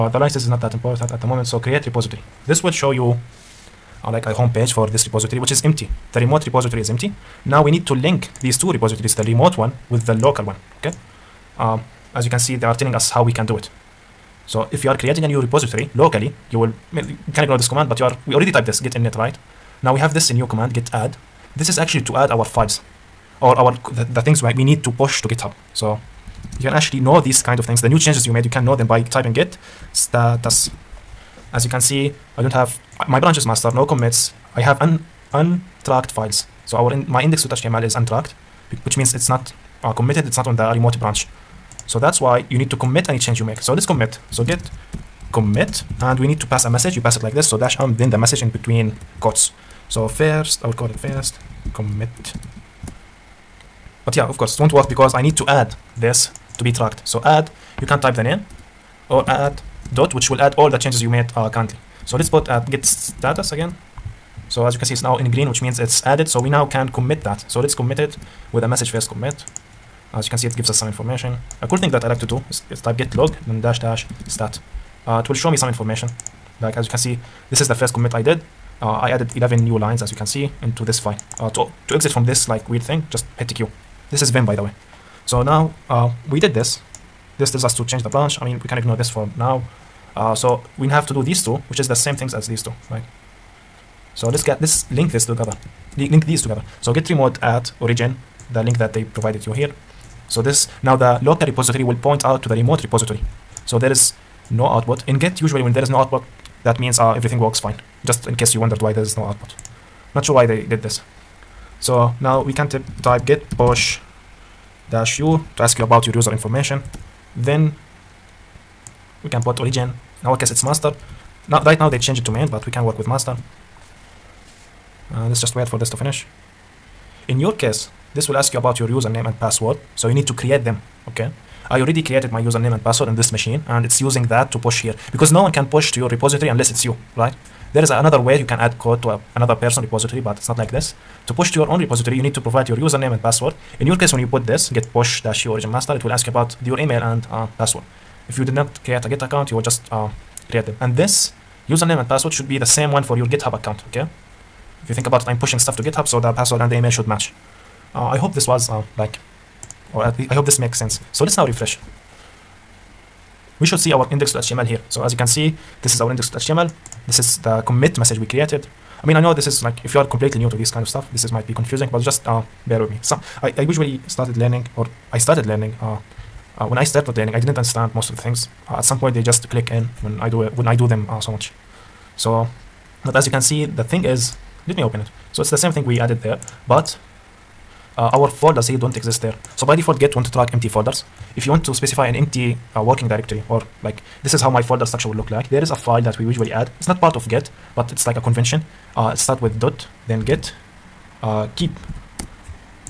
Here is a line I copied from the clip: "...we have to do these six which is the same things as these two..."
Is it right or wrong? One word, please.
wrong.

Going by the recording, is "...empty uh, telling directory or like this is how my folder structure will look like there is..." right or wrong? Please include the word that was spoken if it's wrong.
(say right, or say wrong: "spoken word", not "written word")
wrong: "working", not "telling".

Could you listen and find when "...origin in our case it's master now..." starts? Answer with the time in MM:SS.
01:59.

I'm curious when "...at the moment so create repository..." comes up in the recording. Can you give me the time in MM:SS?
00:01.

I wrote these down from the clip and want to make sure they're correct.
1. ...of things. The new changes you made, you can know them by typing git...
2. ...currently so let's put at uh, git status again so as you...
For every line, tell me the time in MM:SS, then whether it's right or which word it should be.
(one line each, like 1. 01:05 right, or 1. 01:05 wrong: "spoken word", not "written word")
1. 00:27 right
2. 01:01 right.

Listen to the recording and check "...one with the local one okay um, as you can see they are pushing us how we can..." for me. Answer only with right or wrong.
wrong.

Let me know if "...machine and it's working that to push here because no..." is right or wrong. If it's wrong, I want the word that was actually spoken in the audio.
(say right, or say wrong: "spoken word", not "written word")
wrong: "using", not "working".